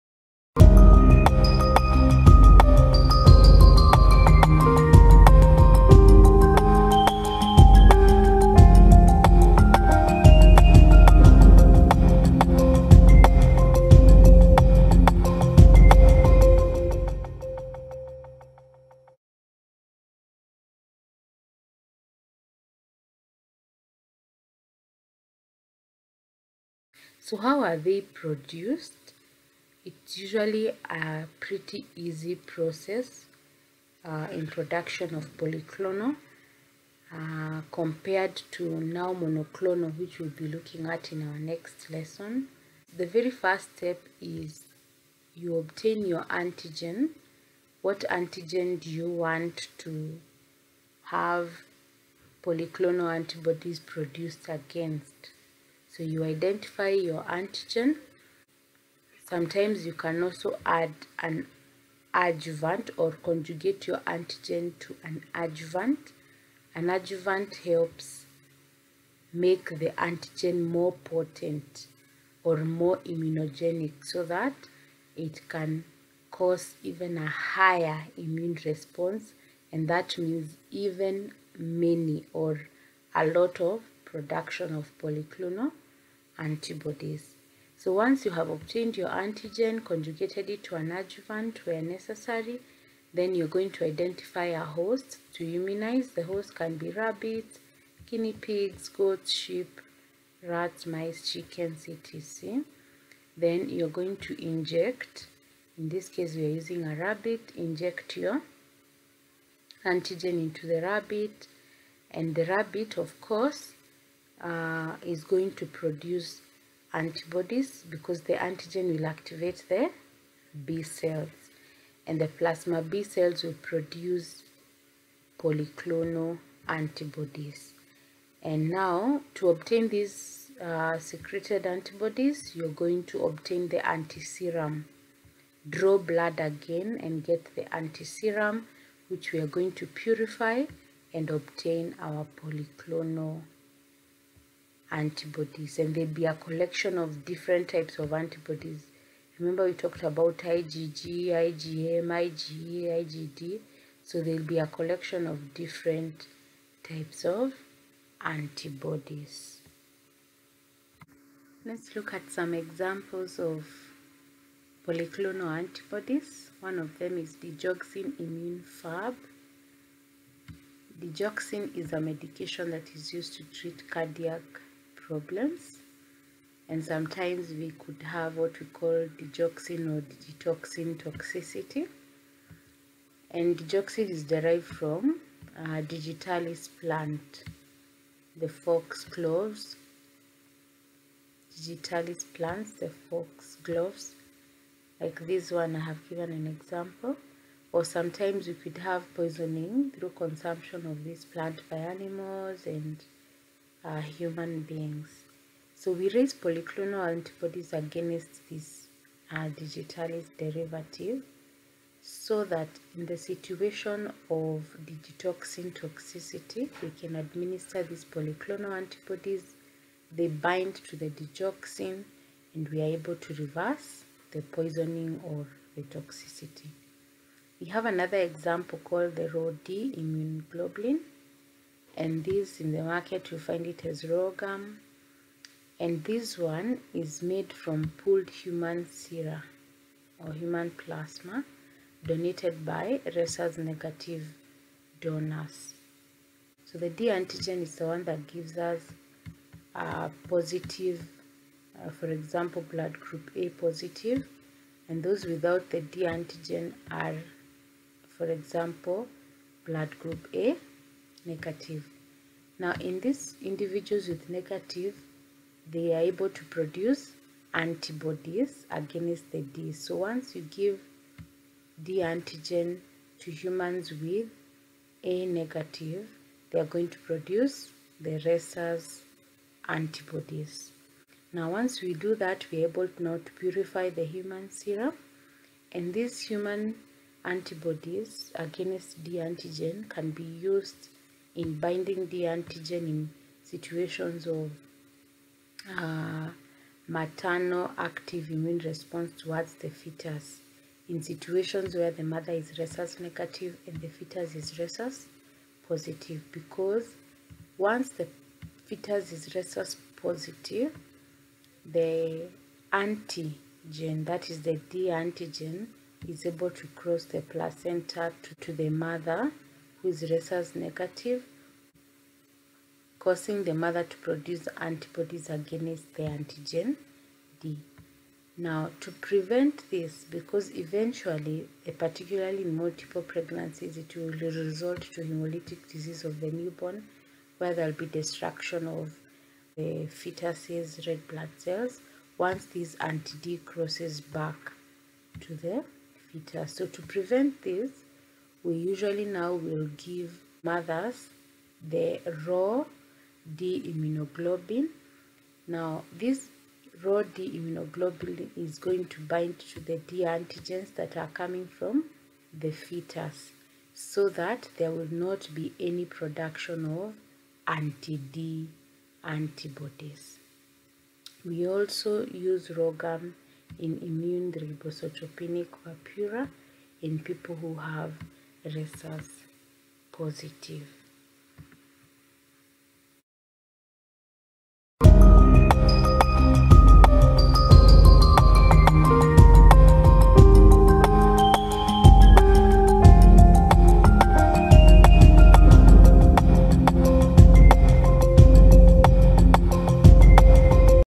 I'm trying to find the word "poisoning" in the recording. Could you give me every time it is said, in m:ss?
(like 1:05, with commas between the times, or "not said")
3:19, 3:44.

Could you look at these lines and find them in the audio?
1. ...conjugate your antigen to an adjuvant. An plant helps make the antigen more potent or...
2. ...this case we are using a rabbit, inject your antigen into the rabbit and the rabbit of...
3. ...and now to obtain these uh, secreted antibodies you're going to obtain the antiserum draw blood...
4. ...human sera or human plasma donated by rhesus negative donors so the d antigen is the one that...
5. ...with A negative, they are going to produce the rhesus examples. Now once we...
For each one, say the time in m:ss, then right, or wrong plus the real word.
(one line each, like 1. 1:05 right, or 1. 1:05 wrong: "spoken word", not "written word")
1. 1:03 wrong: "adjuvant", not "plant"
2. 1:45 right
3. 2:08 right
4. 3:58 right
5. 4:33 wrong: "antibodies", not "examples".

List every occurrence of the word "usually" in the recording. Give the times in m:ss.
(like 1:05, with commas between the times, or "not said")
0:30, 5:48.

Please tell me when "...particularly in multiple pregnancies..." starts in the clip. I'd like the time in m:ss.
5:31.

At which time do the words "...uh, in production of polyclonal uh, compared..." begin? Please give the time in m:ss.
0:34.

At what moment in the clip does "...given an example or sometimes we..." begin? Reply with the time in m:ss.
3:16.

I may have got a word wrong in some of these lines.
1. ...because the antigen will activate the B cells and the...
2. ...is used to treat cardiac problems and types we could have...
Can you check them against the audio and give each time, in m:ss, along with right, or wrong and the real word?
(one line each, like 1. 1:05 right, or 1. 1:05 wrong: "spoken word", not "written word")
1. 1:57 right
2. 2:52 wrong: "sometimes", not "types".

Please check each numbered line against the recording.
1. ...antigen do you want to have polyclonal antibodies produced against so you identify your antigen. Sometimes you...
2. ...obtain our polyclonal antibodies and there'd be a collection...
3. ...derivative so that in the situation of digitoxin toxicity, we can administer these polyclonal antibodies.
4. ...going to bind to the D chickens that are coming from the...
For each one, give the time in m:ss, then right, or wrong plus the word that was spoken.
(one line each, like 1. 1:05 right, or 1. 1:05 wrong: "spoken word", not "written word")
1. 0:48 right
2. 2:21 right
3. 3:30 right
4. 5:58 wrong: "antigens", not "chickens".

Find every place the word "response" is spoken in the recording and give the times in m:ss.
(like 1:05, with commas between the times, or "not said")
1:18, 4:58.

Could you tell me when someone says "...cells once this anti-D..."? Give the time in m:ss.
5:41.